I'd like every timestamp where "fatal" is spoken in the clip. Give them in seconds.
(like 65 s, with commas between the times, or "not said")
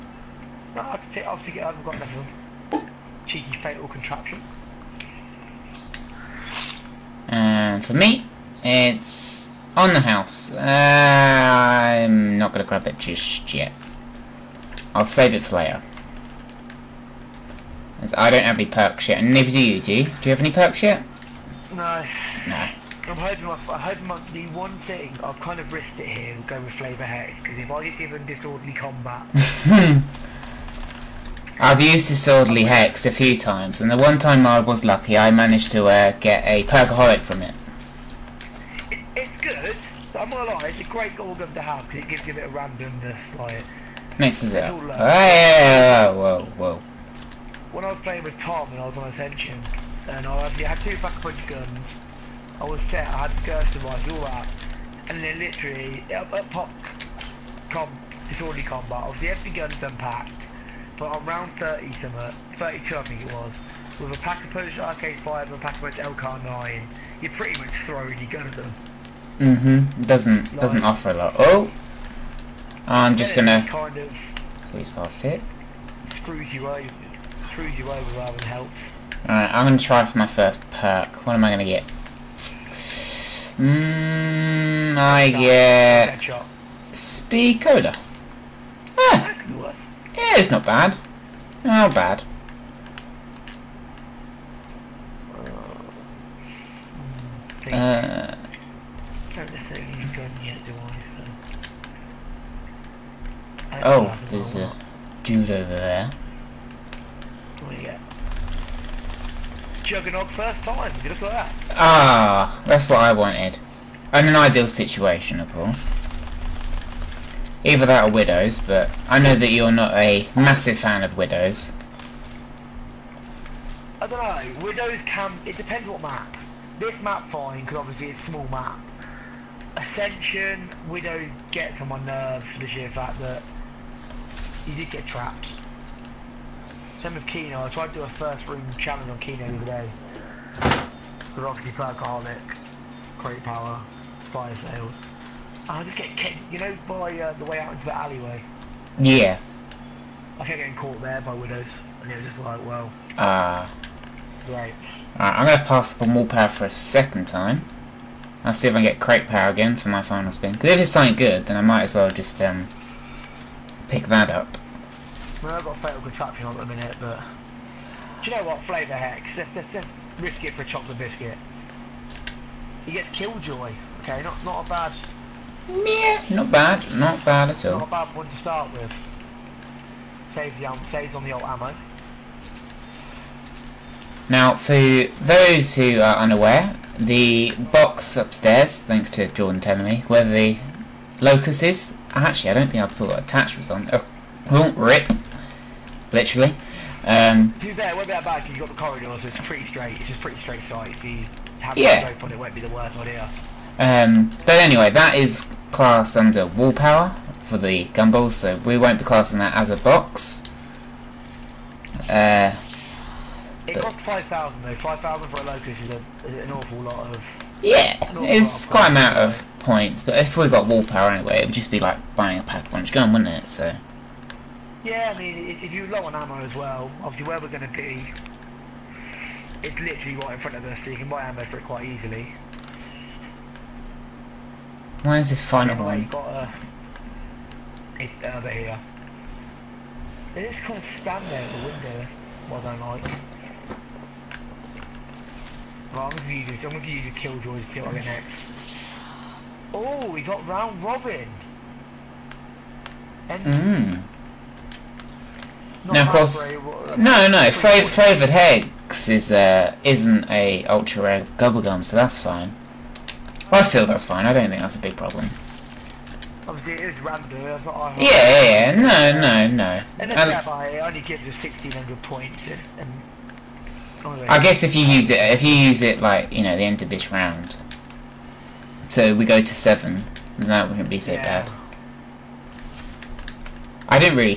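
3 s, 165 s.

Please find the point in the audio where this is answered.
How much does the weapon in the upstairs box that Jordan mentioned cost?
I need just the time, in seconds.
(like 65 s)
214 s.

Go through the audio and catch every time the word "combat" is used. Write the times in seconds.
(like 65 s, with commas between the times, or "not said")
28 s, 58 s.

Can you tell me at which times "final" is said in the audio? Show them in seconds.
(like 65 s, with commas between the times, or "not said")
160 s, 235 s.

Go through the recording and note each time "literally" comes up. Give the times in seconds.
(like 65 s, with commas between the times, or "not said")
55 s, 196 s, 229 s.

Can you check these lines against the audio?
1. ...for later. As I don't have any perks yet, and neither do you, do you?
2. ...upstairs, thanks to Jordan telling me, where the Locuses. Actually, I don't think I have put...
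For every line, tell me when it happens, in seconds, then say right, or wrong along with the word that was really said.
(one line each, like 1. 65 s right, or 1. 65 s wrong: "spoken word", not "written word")
1. 15 s right
2. 188 s right.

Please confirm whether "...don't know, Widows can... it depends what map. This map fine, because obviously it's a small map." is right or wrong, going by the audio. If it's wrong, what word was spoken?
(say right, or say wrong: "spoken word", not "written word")
right.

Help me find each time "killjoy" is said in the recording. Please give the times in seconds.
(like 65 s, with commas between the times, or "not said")
173 s, 247 s.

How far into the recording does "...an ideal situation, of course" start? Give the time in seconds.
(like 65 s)
114 s.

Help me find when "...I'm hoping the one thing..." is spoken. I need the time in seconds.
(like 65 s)
23 s.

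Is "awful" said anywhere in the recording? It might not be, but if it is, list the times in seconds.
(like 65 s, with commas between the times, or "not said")
216 s.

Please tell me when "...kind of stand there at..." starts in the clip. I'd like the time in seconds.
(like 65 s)
240 s.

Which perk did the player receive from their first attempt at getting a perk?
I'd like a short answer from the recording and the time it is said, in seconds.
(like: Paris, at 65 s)
Speed Cola, at 86 s.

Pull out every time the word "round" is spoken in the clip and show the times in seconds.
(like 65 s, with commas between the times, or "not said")
61 s, 250 s, 277 s.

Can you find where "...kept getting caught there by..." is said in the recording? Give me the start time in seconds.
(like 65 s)
150 s.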